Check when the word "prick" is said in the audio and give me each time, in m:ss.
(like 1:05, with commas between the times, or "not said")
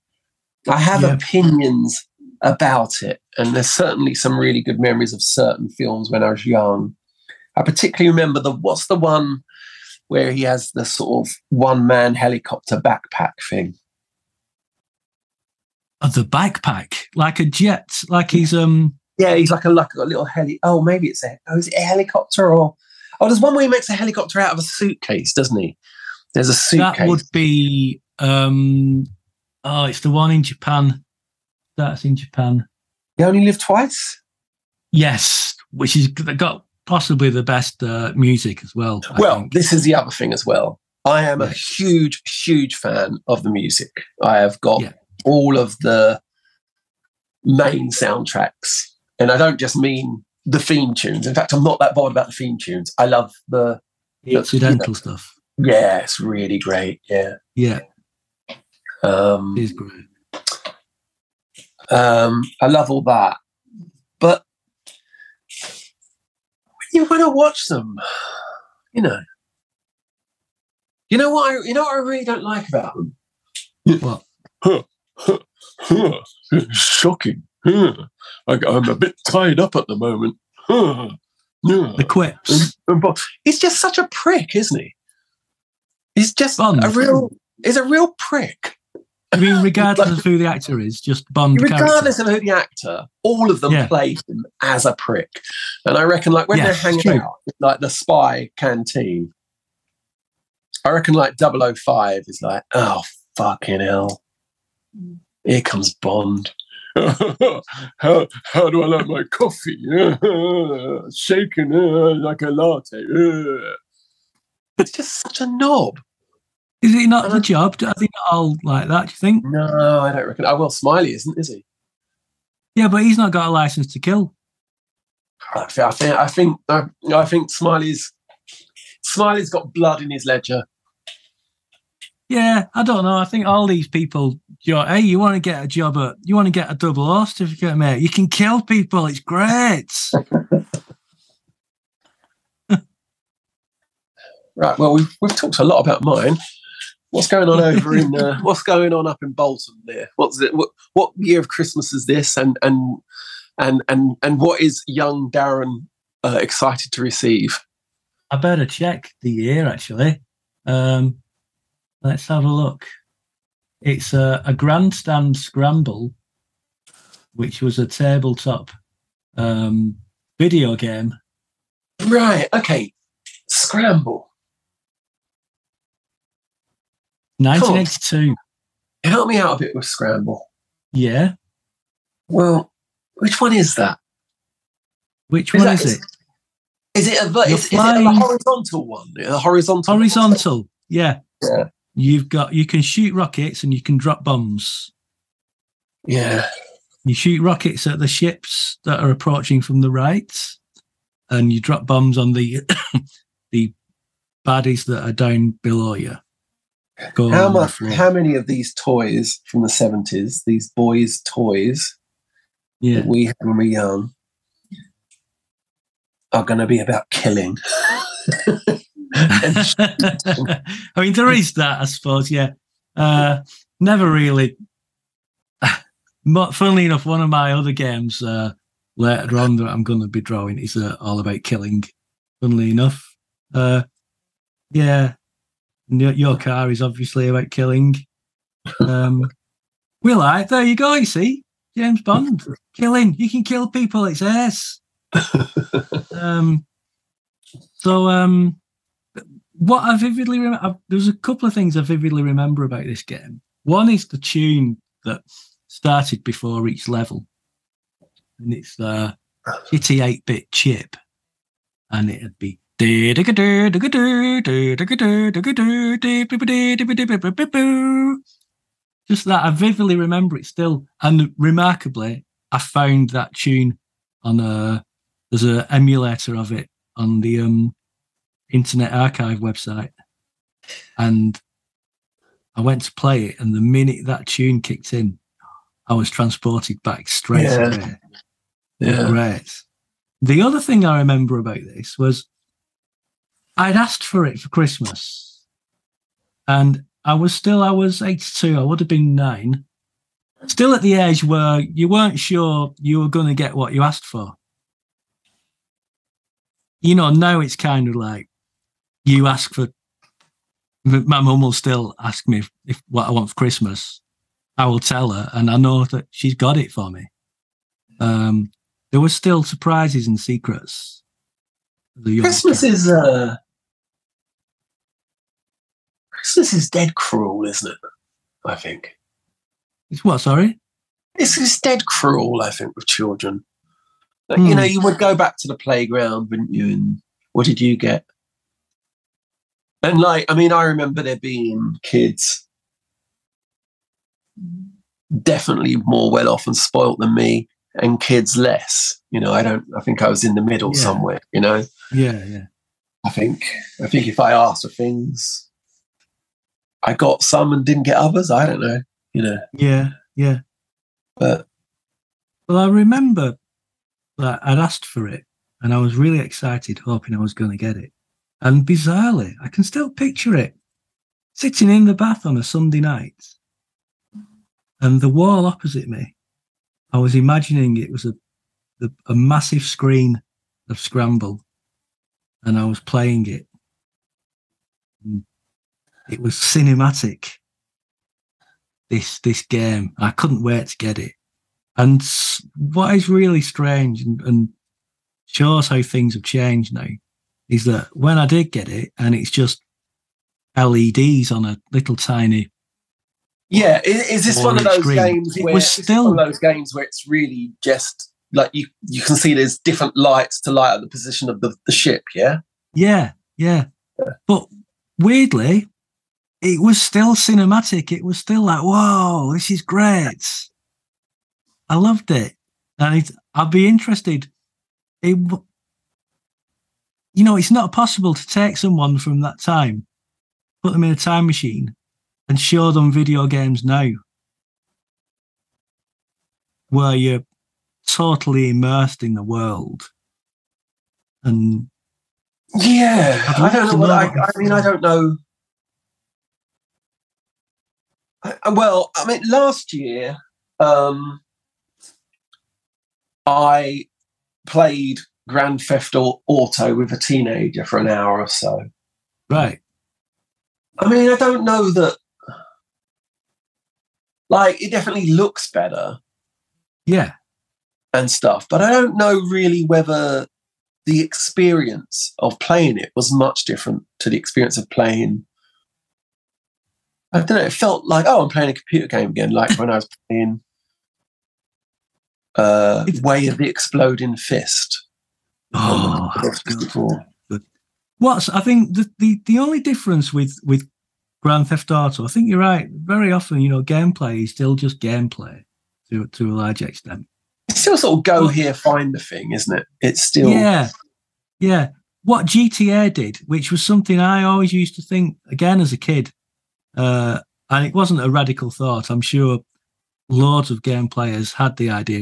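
1:24, 1:28, 1:34.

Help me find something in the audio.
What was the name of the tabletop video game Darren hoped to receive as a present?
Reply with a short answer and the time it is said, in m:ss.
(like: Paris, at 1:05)
Grandstand Scramble, at 2:44.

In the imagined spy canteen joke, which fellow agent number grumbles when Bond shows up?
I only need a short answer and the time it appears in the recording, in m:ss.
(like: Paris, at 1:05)
005, at 1:41.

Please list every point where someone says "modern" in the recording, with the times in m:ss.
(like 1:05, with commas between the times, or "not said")
not said.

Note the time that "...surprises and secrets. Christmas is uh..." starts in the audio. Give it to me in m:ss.
5:19.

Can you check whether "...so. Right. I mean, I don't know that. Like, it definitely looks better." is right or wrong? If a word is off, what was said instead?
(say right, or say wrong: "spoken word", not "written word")
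right.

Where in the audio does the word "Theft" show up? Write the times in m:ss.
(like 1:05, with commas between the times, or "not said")
7:35, 8:11.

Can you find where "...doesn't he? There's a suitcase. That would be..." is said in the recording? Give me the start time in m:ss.
0:25.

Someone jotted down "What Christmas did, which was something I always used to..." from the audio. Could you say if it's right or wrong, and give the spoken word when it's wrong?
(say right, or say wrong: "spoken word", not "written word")
wrong: "GTA", not "Christmas".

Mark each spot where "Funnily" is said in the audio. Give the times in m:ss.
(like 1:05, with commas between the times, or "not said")
3:46, 3:52.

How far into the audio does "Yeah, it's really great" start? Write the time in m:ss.
0:55.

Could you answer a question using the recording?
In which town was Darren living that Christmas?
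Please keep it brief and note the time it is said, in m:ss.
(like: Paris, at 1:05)
Bolton, at 2:29.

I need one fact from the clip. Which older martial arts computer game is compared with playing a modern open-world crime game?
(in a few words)
Way of the Exploding Fist.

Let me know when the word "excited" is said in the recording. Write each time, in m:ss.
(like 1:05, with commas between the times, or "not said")
2:36, 6:06.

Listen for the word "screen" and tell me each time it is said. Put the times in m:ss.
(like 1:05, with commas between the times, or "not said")
6:19, 6:44.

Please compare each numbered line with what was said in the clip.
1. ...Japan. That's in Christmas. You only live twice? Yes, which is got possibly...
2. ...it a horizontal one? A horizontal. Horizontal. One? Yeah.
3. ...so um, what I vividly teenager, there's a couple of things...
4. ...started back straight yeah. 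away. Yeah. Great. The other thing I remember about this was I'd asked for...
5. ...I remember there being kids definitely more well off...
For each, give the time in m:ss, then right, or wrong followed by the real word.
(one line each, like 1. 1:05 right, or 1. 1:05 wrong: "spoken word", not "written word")
1. 0:30 wrong: "Japan", not "Christmas"
2. 3:07 right
3. 4:07 wrong: "remember", not "teenager"
4. 4:46 wrong: "transported", not "started"
5. 5:40 right.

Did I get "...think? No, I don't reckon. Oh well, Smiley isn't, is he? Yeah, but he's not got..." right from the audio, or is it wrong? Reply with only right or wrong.
right.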